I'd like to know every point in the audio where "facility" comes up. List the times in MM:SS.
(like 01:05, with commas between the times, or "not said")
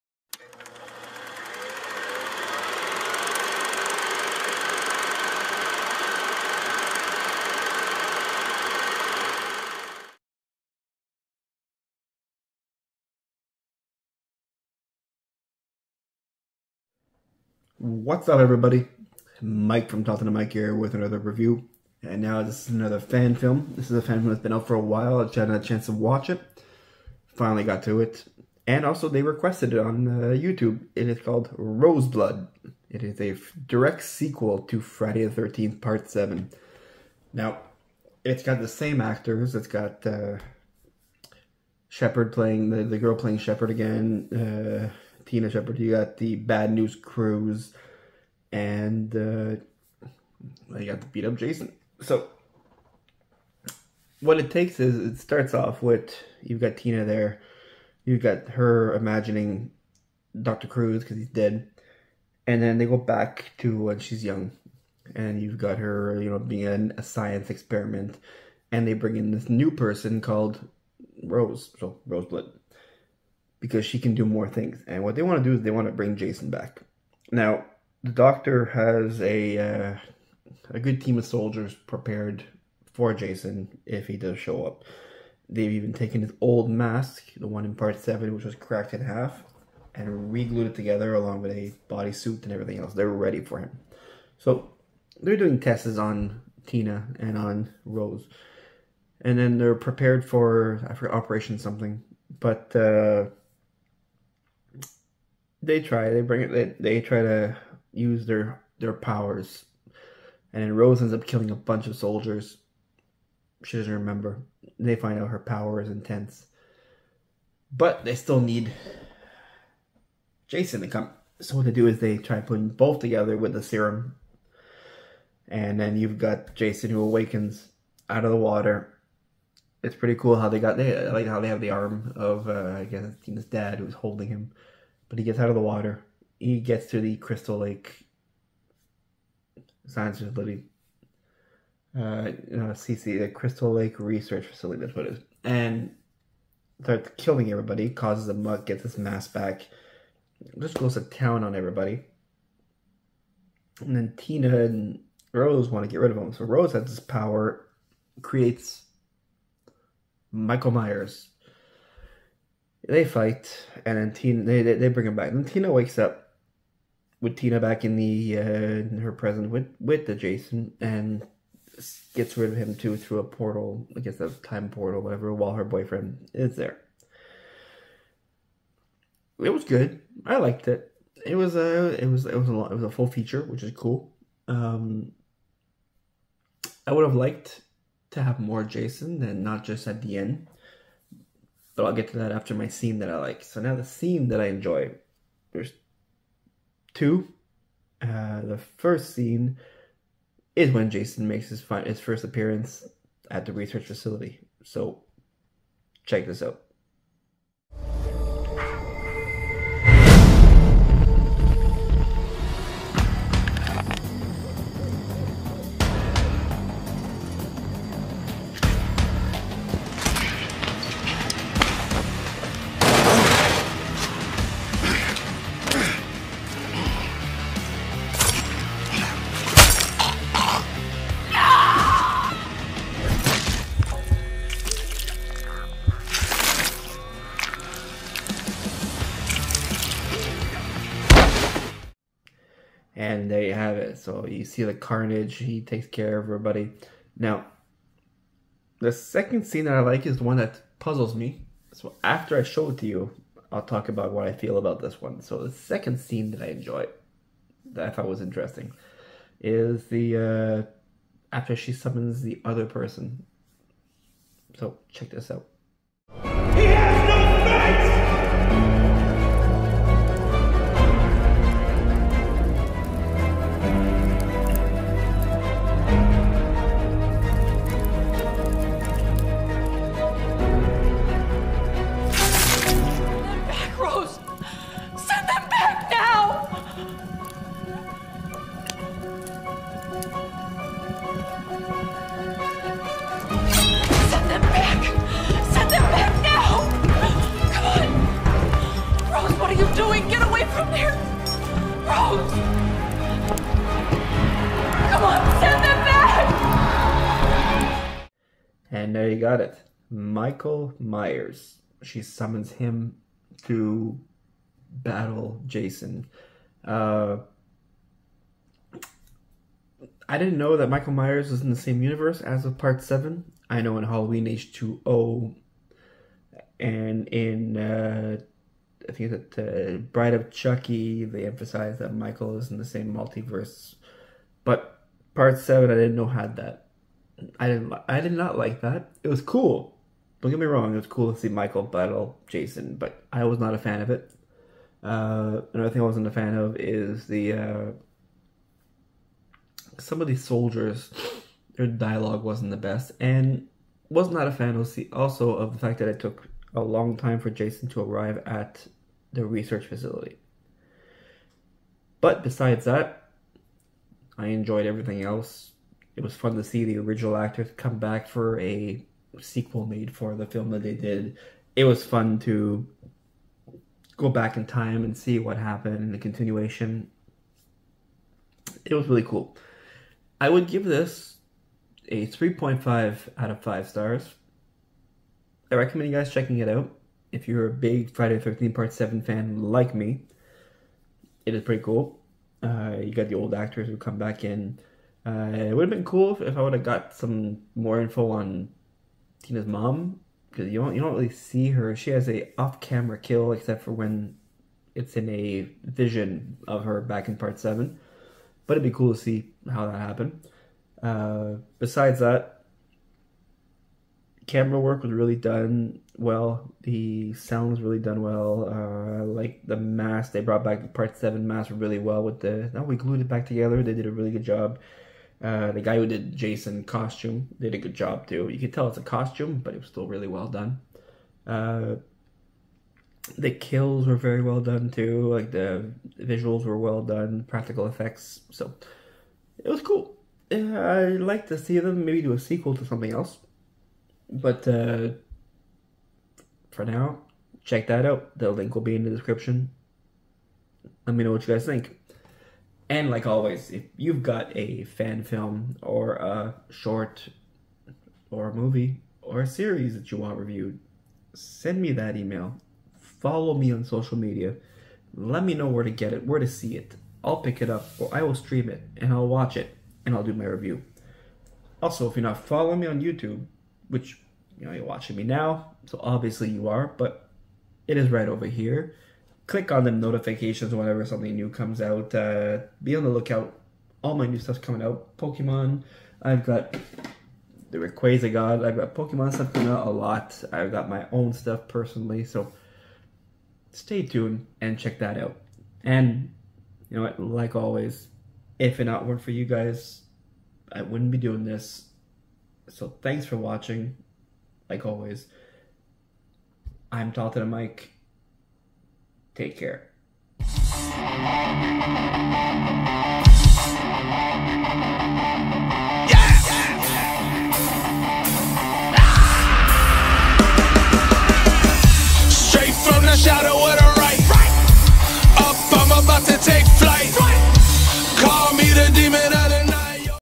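02:20, 02:24, 03:23, 05:59.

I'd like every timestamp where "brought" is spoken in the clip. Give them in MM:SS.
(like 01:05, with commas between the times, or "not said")
07:00.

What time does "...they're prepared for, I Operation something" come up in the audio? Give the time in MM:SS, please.
01:39.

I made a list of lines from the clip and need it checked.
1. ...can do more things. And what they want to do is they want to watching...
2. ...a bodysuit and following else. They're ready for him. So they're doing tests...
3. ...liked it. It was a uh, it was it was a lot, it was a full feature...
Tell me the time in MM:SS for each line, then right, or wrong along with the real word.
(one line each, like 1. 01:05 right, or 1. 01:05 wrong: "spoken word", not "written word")
1. 01:13 wrong: "bring", not "watching"
2. 01:31 wrong: "everything", not "following"
3. 03:00 right.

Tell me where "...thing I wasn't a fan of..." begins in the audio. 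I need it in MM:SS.
05:45.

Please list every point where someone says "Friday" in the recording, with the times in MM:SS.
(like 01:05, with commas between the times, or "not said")
00:34, 06:27.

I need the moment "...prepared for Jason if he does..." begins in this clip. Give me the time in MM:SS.
01:21.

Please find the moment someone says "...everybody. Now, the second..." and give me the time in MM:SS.
04:06.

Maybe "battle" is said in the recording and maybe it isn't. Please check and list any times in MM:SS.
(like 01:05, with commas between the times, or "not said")
05:14, 05:41.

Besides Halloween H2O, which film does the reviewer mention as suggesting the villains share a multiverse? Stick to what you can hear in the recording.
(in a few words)
Bride of Chucky.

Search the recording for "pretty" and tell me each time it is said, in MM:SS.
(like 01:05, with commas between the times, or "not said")
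02:09, 06:31.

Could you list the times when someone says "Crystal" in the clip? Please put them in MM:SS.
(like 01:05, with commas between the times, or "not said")
02:17, 02:23.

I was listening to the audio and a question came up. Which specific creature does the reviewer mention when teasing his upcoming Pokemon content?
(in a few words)
Rayquaza.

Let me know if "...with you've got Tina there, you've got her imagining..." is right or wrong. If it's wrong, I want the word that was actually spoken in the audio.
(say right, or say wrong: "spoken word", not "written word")
right.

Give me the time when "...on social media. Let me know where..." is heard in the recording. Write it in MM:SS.
07:43.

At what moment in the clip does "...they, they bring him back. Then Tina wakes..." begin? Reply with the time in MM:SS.
02:44.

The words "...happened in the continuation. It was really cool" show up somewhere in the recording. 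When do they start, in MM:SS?
06:15.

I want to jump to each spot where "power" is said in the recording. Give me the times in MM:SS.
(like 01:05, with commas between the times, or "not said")
01:48, 01:55, 02:37.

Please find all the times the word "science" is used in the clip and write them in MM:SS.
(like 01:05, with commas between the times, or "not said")
01:07, 02:19.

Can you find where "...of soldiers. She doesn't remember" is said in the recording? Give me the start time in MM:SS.
01:51.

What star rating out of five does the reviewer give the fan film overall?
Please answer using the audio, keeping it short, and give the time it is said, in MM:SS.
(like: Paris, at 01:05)
3.5, at 06:22.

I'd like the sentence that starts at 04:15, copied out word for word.
So the second scene that I enjoy, that I thought was interesting, is the uh, after she summons the other person.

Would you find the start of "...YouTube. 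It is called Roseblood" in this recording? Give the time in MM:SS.
00:30.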